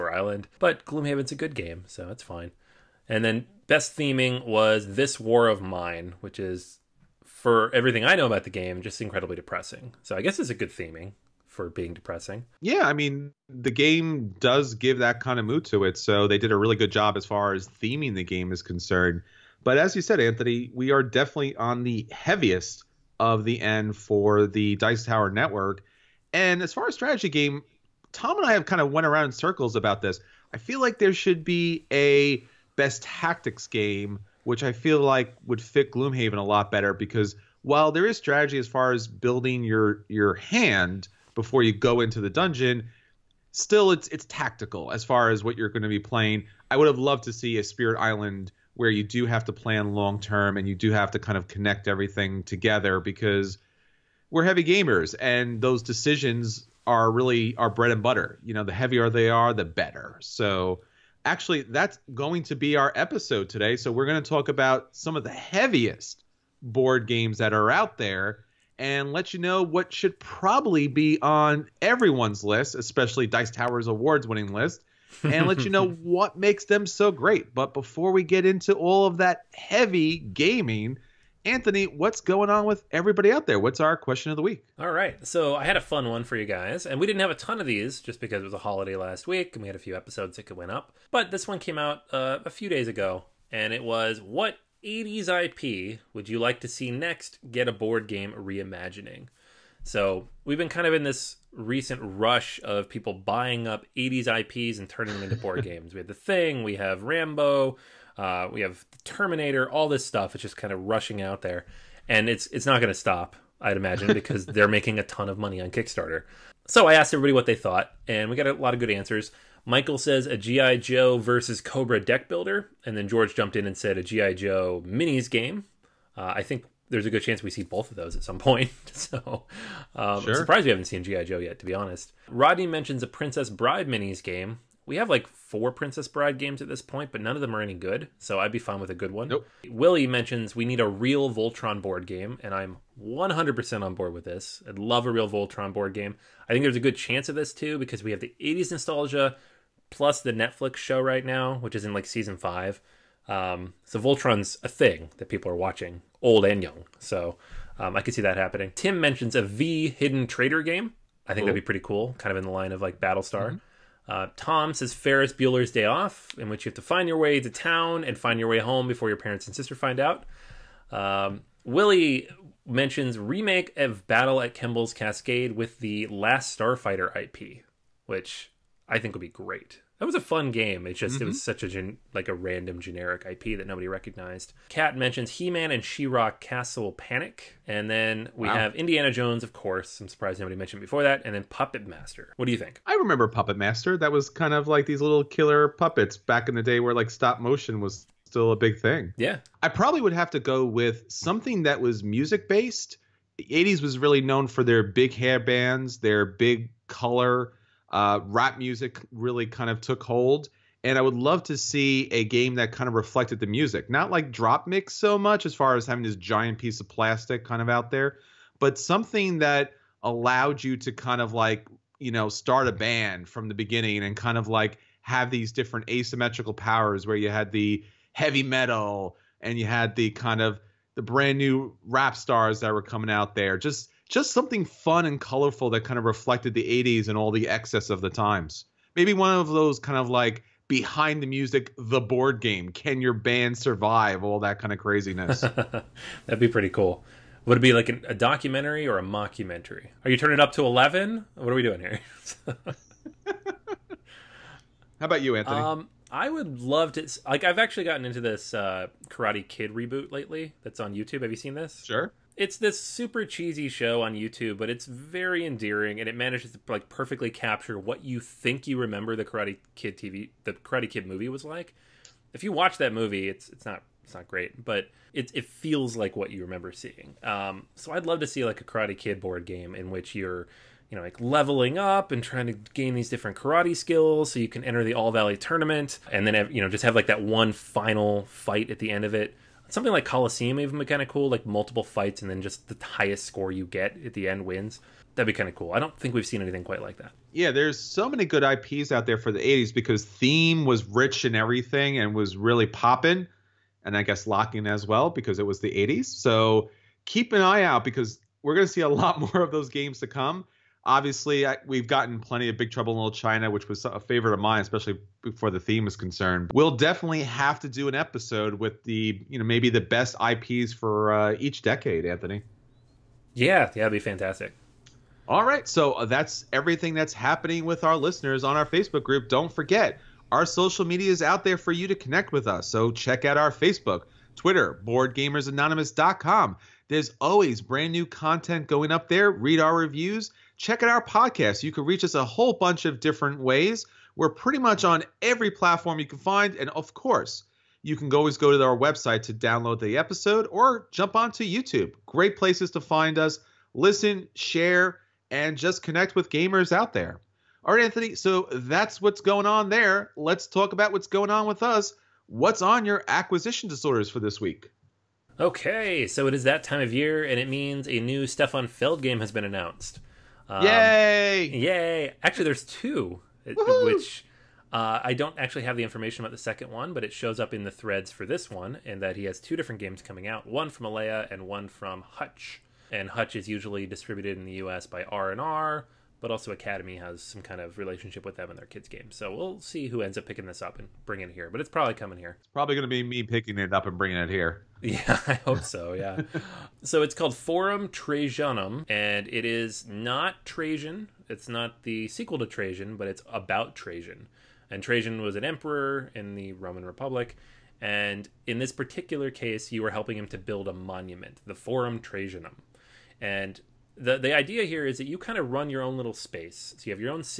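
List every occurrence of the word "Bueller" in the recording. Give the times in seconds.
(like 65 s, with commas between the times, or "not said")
165 s.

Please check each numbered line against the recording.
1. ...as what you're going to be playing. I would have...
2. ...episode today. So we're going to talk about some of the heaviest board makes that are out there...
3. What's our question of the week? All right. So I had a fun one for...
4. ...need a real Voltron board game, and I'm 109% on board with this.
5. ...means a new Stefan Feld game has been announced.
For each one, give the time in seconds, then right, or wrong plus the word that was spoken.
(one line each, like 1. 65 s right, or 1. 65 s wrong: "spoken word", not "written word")
1. 45 s right
2. 62 s wrong: "games", not "makes"
3. 83 s right
4. 140 s wrong: "100", not "109"
5. 367 s right.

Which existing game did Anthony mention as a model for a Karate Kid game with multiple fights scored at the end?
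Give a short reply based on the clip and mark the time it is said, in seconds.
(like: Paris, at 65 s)
Coliseum, at 290 s.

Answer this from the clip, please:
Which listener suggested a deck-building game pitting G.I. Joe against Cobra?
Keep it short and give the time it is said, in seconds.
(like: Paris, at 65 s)
Michael, at 119 s.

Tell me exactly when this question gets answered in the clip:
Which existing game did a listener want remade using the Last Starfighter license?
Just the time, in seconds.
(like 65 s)
174 s.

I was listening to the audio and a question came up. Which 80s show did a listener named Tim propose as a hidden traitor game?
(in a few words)
V.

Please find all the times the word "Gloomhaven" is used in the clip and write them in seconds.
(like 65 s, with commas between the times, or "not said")
0 s, 35 s.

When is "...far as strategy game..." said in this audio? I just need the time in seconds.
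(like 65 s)
26 s.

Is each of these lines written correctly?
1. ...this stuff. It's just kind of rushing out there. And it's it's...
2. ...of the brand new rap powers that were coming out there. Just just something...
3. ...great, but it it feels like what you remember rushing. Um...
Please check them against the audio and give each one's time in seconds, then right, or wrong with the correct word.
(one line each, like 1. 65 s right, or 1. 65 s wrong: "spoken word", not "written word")
1. 109 s right
2. 230 s wrong: "stars", not "powers"
3. 274 s wrong: "seeing", not "rushing".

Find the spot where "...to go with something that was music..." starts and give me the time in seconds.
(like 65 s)
200 s.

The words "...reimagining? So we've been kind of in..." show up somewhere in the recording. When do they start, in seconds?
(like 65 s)
98 s.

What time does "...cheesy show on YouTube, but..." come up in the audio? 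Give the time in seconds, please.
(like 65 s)
263 s.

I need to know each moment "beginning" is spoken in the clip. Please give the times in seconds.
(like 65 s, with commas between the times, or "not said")
223 s.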